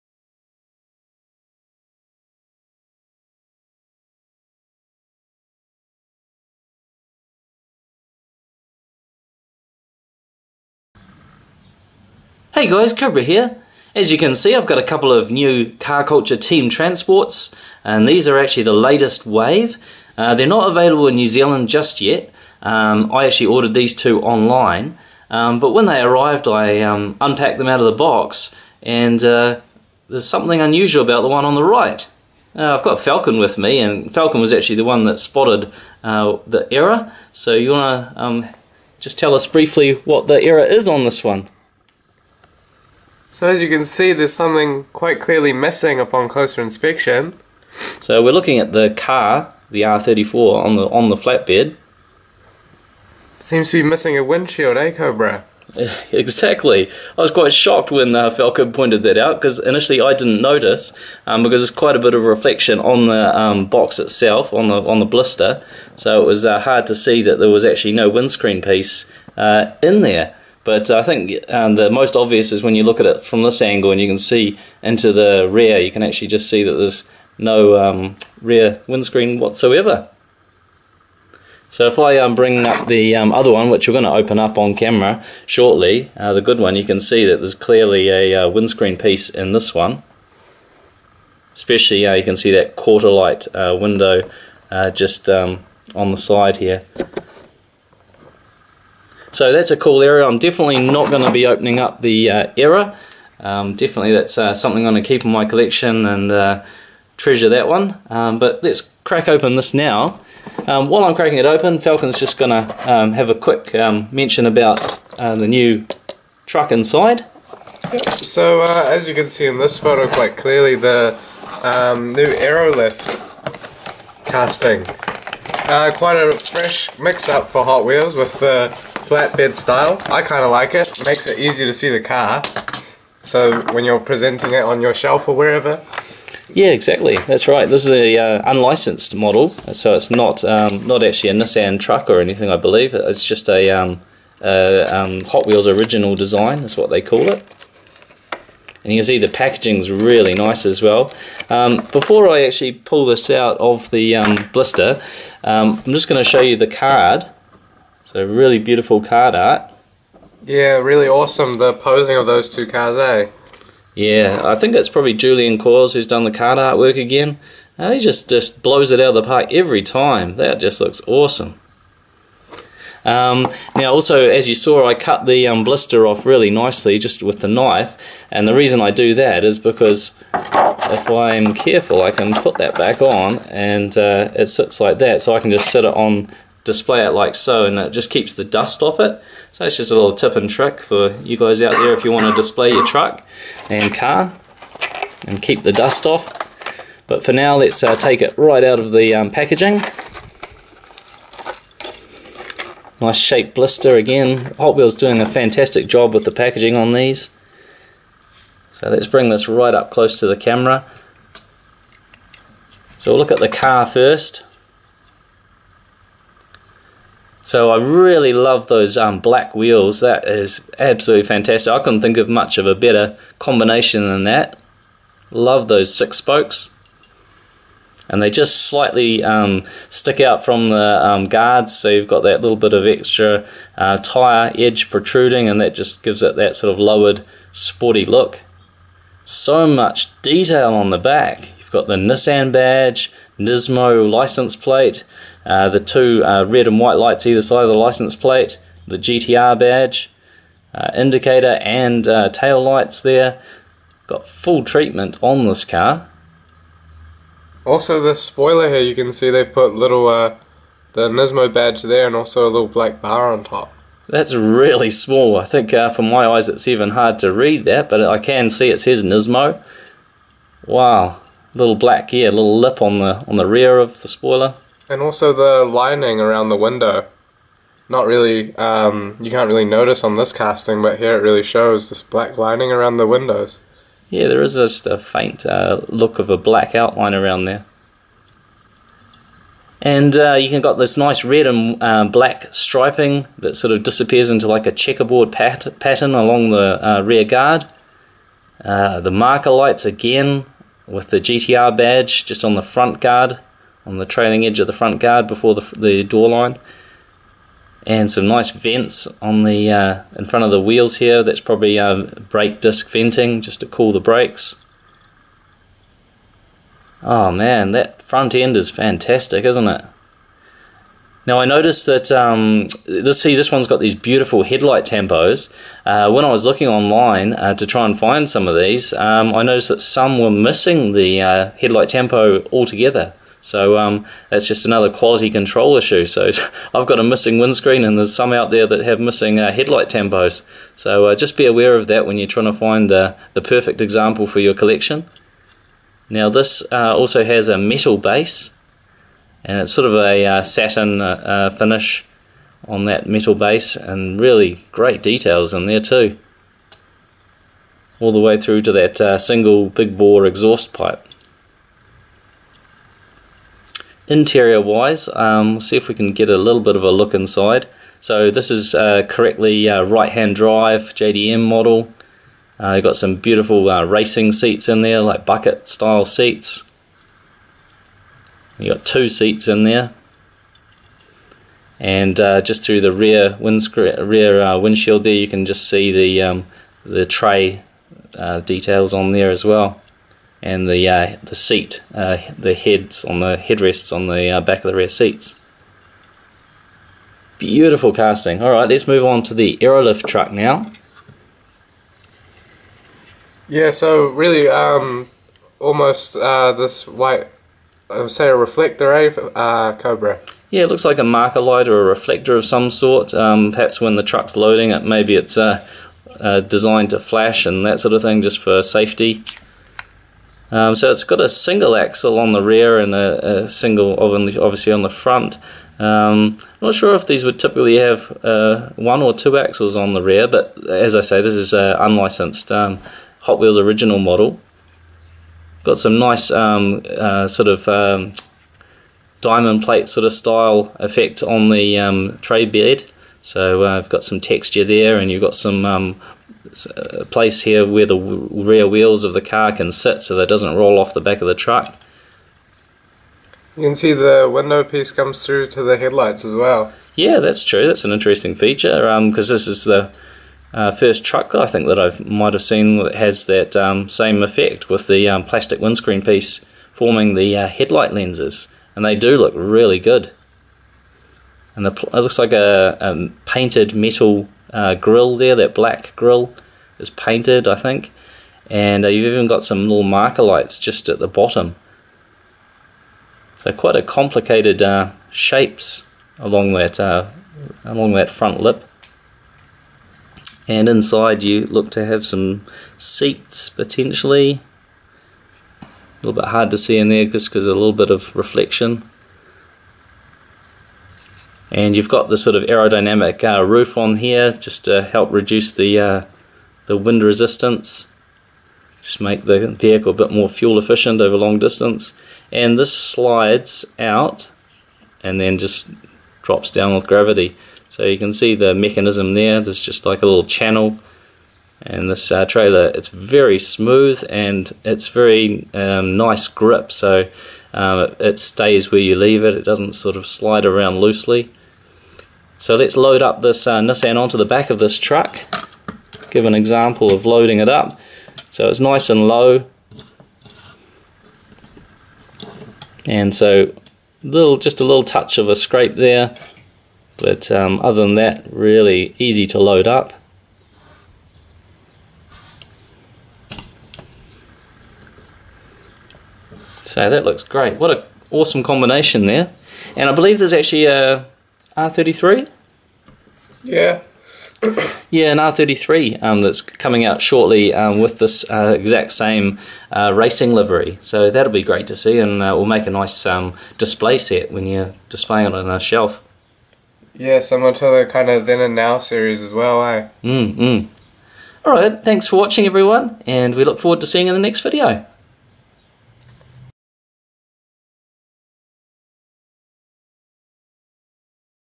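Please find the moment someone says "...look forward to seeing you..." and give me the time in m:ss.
9:43.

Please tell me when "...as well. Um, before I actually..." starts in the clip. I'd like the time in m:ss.
2:30.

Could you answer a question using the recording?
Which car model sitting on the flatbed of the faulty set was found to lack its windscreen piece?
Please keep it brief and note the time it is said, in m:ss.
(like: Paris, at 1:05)
R34, at 0:49.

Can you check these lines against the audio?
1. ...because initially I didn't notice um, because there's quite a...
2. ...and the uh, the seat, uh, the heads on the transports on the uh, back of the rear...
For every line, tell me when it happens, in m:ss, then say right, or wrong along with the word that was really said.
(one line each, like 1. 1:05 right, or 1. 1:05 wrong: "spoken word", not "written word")
1. 0:59 right
2. 6:30 wrong: "headrests", not "transports".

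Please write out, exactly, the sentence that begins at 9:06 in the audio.
But um, other than that, really easy to load up.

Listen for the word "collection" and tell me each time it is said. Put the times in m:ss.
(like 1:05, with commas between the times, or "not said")
1:45, 5:44.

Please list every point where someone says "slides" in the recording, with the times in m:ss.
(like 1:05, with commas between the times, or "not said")
8:32, 8:50.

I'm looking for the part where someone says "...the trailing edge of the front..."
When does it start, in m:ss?
5:03.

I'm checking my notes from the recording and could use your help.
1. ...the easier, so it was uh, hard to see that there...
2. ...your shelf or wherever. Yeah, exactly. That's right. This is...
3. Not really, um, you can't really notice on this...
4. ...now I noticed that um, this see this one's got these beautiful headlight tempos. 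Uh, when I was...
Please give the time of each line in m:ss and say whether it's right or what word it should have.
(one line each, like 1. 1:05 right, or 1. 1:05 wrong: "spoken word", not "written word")
1. 1:04 wrong: "blister", not "easier"
2. 2:14 right
3. 4:37 right
4. 5:21 right.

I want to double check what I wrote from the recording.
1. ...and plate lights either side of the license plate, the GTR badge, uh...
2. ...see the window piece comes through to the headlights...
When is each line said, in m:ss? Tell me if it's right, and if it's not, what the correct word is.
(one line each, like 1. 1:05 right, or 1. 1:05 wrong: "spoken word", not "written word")
1. 4:06 wrong: "white", not "plate"
2. 7:33 right.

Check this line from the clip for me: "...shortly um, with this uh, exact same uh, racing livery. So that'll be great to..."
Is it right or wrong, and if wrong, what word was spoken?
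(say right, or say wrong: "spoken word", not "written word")
right.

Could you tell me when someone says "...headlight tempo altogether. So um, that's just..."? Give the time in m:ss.
5:31.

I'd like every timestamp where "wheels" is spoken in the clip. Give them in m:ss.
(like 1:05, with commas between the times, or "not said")
2:07, 2:25, 3:24, 3:39, 5:10, 7:13, 7:28.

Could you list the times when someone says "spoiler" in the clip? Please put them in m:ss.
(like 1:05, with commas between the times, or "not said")
4:18, 4:34.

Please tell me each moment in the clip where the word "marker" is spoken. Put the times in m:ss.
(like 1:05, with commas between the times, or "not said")
4:59, 6:51, 7:59.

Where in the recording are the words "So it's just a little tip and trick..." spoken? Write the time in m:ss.
3:09.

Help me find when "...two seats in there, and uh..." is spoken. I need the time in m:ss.
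6:18.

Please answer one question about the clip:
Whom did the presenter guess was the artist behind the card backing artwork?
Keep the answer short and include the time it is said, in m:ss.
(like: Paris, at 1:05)
Julian Cause, at 2:45.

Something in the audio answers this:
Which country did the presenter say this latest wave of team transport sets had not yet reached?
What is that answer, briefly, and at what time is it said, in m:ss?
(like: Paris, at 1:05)
New Zealand, at 0:21.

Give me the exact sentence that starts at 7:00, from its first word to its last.
Um, so it's got a single axle on the rear and a, a single obviously on the front.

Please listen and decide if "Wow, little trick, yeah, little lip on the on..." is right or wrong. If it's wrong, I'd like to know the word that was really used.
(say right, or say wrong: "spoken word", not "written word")
wrong: "black", not "trick".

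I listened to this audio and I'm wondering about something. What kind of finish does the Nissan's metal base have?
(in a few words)
satin.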